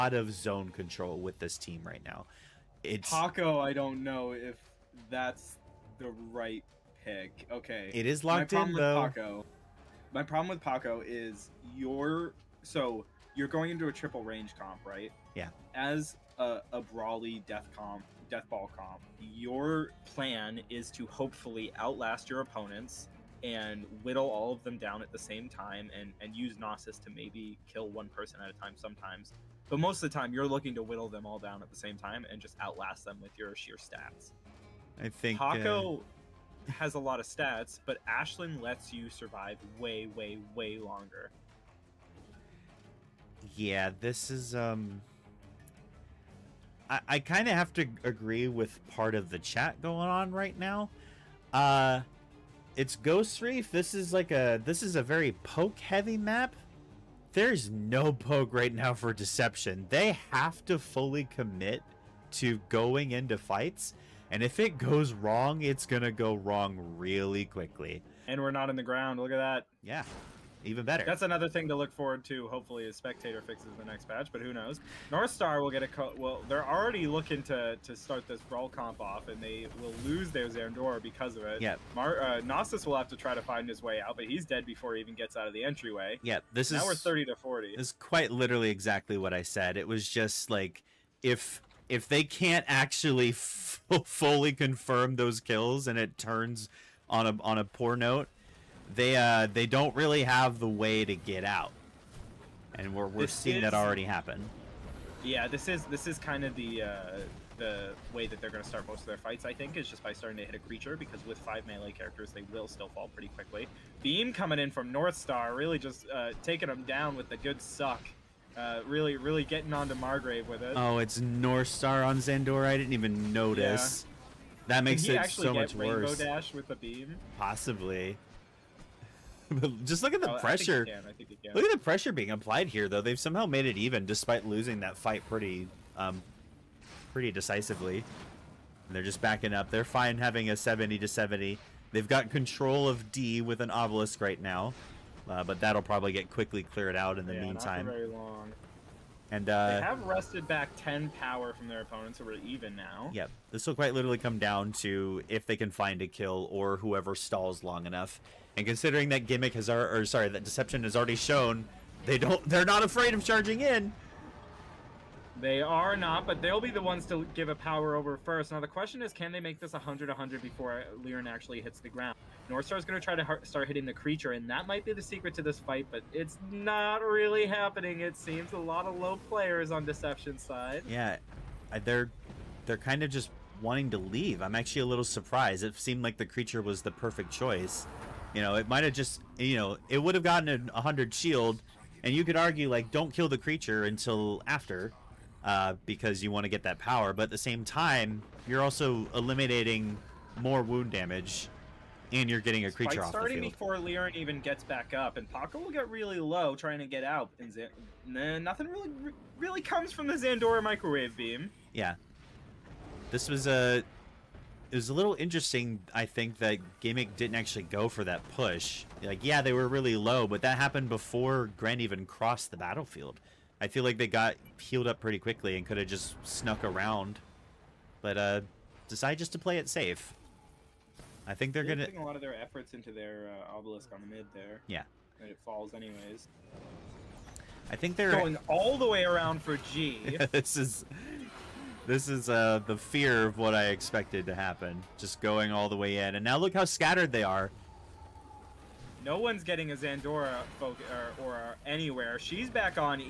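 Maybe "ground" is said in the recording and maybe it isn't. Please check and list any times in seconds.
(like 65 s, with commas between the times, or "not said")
68 s, 171 s.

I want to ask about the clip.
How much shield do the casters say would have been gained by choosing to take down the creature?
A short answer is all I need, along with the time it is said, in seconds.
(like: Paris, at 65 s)
100, at 190 s.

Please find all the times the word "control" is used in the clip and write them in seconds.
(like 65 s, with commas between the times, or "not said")
0 s, 142 s.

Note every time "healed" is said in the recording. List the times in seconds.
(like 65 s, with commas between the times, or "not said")
224 s.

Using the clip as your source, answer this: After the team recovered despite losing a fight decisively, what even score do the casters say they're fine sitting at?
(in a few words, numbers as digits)
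70 to 70.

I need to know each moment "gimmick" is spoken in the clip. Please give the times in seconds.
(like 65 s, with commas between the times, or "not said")
159 s, 216 s.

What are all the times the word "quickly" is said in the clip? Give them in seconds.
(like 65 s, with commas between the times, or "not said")
67 s, 113 s, 146 s, 225 s.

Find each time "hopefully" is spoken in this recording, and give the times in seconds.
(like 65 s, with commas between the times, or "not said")
21 s, 72 s.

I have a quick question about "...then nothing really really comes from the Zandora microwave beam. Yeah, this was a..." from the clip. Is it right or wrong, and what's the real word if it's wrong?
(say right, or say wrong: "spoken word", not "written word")
right.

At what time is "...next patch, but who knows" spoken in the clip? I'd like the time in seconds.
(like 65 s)
73 s.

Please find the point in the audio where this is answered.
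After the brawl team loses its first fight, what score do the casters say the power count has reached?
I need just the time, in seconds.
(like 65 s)
86 s.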